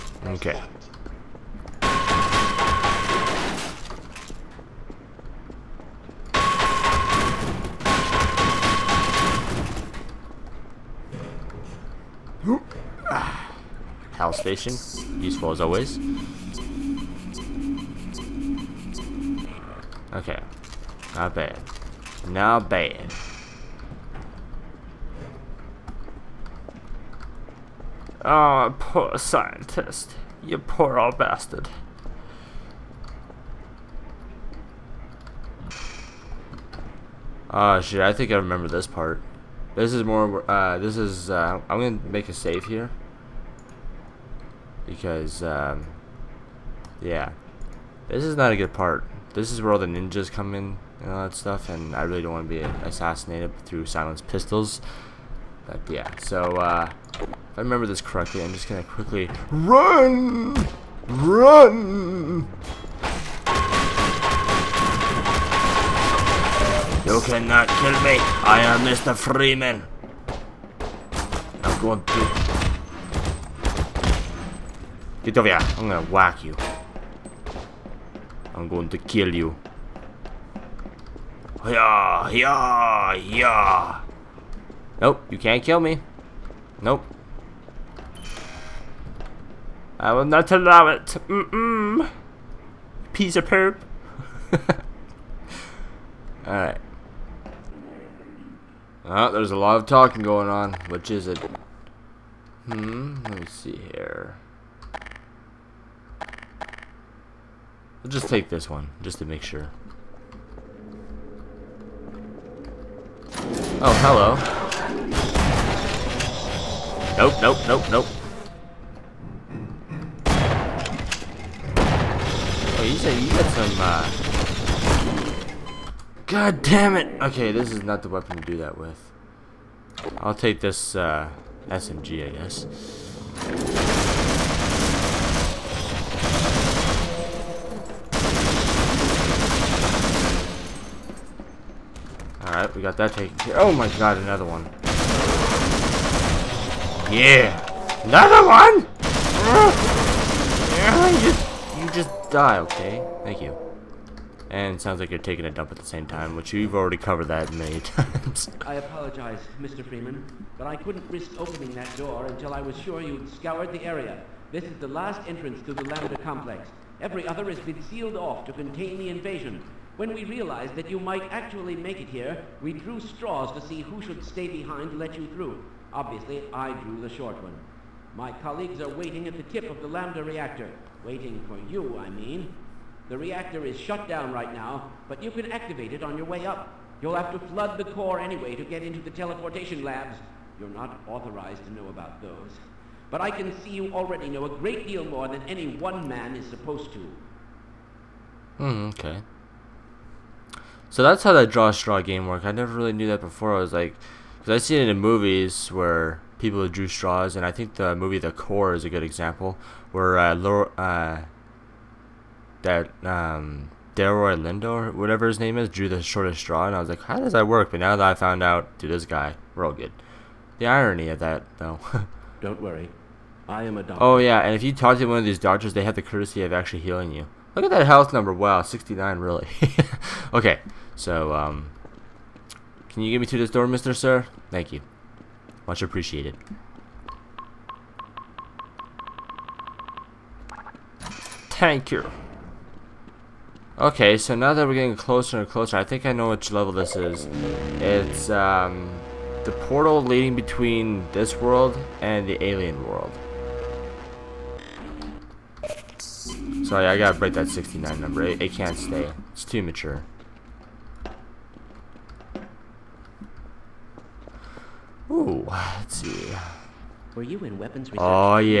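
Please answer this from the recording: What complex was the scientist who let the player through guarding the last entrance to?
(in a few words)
Lambda complex.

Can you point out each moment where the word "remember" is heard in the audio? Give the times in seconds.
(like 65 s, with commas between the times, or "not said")
38 s, 57 s.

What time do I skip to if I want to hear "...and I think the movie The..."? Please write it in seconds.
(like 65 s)
207 s.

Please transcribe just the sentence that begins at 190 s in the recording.
You're not authorized to know about those.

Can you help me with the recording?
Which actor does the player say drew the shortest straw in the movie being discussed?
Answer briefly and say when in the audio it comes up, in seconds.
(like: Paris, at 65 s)
Delroy Lindo, at 213 s.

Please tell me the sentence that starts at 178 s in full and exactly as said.
My colleagues are waiting at the tip of the Lambda reactor.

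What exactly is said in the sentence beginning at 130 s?
I'll take this, uh, SMG, I guess.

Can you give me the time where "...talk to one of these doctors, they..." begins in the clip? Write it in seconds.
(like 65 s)
224 s.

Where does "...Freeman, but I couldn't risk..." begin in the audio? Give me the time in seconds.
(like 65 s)
159 s.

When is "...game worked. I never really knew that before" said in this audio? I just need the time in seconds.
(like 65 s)
202 s.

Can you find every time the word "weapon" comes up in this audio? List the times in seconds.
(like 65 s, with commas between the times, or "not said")
128 s, 267 s.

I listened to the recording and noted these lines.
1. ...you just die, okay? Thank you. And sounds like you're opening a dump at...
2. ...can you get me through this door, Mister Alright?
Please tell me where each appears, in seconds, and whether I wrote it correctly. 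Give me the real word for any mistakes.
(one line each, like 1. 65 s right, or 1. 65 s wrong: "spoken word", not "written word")
1. 151 s wrong: "taking", not "opening"
2. 232 s wrong: "Sir", not "Alright".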